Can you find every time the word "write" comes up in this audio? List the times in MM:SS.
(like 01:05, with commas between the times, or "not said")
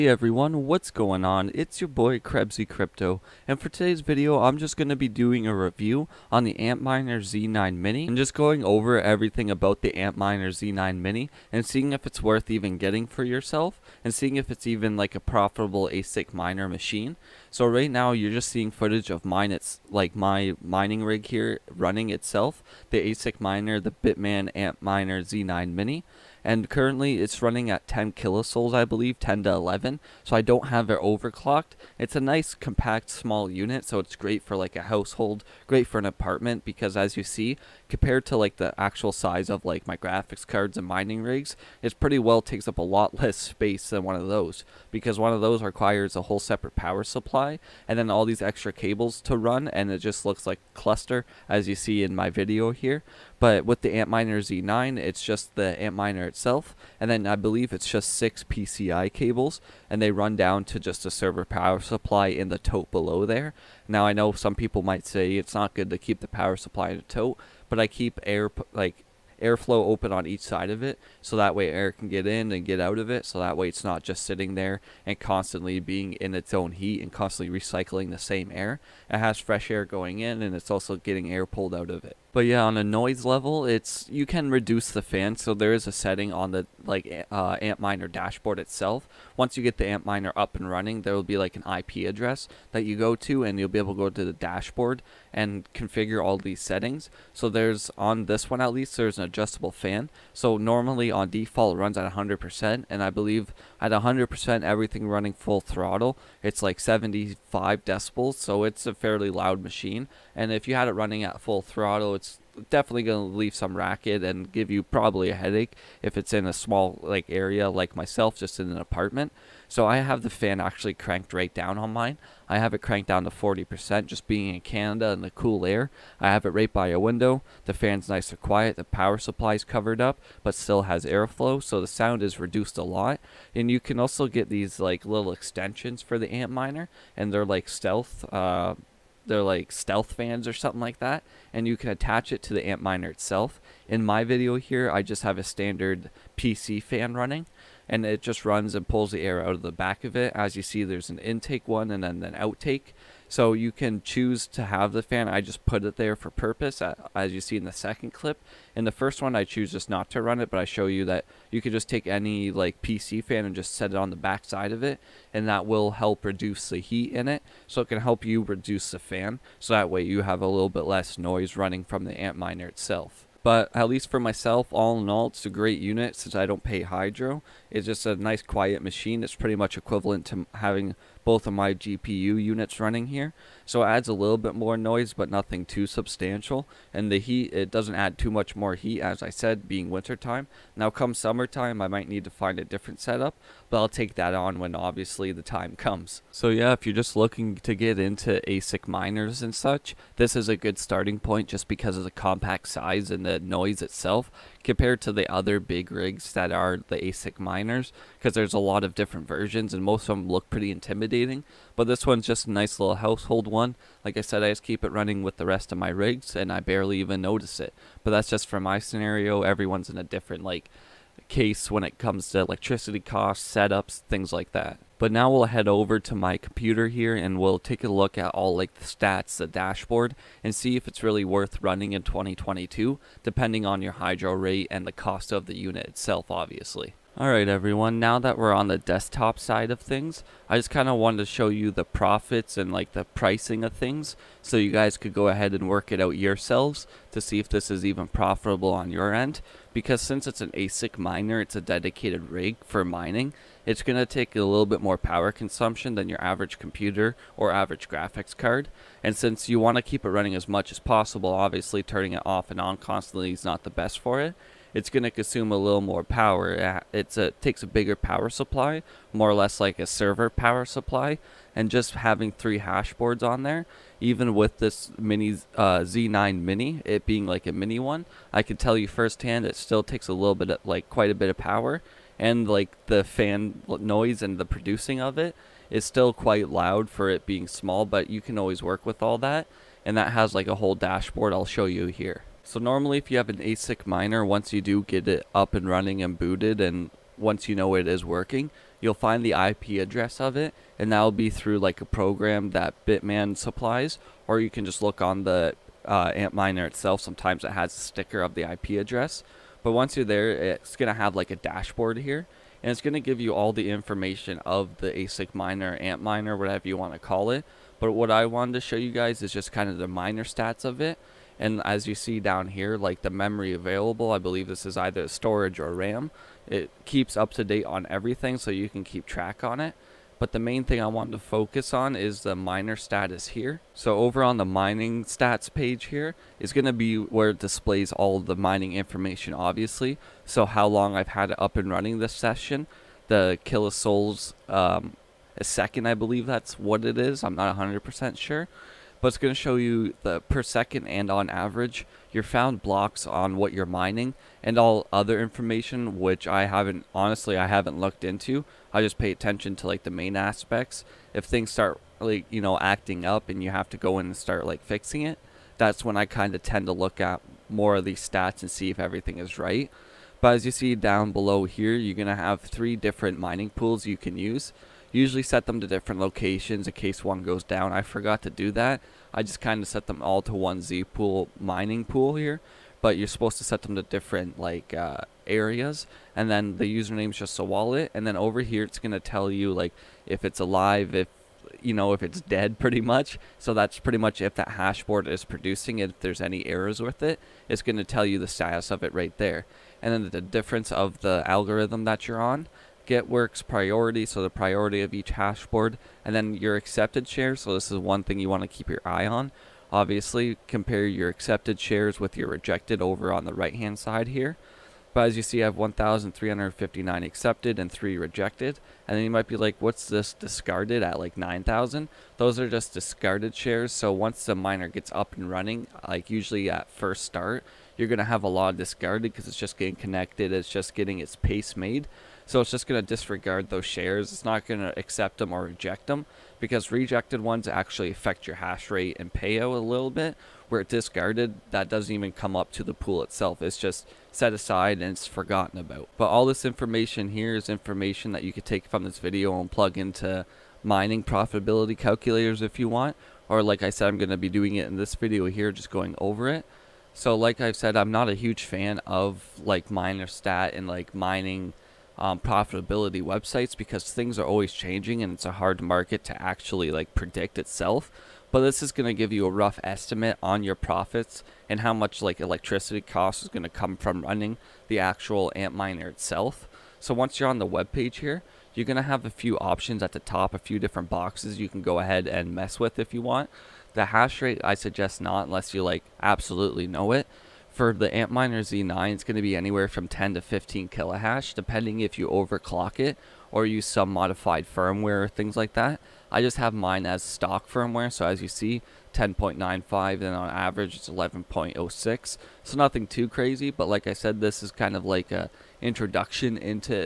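not said.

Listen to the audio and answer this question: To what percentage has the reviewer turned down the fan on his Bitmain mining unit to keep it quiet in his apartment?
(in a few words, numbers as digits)
40%.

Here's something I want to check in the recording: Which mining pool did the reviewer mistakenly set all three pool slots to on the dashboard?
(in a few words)
Zpool.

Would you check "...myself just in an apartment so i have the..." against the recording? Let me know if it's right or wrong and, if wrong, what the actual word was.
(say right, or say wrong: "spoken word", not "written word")
right.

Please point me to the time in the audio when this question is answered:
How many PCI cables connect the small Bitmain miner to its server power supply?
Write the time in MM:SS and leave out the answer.
00:58.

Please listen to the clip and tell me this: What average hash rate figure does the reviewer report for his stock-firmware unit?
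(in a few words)
11.06.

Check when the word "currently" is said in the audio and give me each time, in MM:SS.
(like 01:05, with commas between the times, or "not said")
00:26.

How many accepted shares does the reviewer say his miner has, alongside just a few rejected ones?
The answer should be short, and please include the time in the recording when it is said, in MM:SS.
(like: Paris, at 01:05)
1,359, at 06:55.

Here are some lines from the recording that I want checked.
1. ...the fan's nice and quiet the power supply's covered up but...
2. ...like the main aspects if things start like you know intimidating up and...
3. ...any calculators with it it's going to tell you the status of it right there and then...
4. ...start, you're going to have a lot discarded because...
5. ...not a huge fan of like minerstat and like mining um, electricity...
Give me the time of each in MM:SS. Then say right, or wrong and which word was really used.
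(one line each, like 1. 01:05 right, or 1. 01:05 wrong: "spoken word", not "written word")
1. 02:07 right
2. 05:59 wrong: "acting", not "intimidating"
3. 06:36 wrong: "errors", not "calculators"
4. 07:07 right
5. 07:37 wrong: "profitability", not "electricity".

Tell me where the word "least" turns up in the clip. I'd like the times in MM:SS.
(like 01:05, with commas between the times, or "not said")
01:38, 02:53.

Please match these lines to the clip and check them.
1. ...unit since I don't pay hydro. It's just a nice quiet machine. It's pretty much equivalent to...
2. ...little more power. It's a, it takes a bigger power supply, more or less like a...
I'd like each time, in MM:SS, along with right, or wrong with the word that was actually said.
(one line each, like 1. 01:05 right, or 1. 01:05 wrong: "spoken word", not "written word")
1. 02:55 right
2. 04:25 right.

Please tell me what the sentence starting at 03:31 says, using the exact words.
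But this one's just a nice little household one.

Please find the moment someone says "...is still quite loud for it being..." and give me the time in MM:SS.
04:45.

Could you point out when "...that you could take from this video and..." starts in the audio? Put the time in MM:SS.
07:28.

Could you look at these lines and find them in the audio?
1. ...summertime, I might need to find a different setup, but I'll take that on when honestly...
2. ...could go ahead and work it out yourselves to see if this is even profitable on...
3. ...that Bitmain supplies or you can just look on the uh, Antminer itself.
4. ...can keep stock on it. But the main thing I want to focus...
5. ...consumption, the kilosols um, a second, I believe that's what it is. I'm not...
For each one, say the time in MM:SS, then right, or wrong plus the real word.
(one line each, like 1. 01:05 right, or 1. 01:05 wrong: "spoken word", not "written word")
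1. 03:11 wrong: "obviously", not "honestly"
2. 04:04 right
3. 05:02 right
4. 05:28 wrong: "track", not "stock"
5. 05:42 wrong: "session", not "consumption".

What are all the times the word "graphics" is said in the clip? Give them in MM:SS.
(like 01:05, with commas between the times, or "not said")
00:39, 04:17.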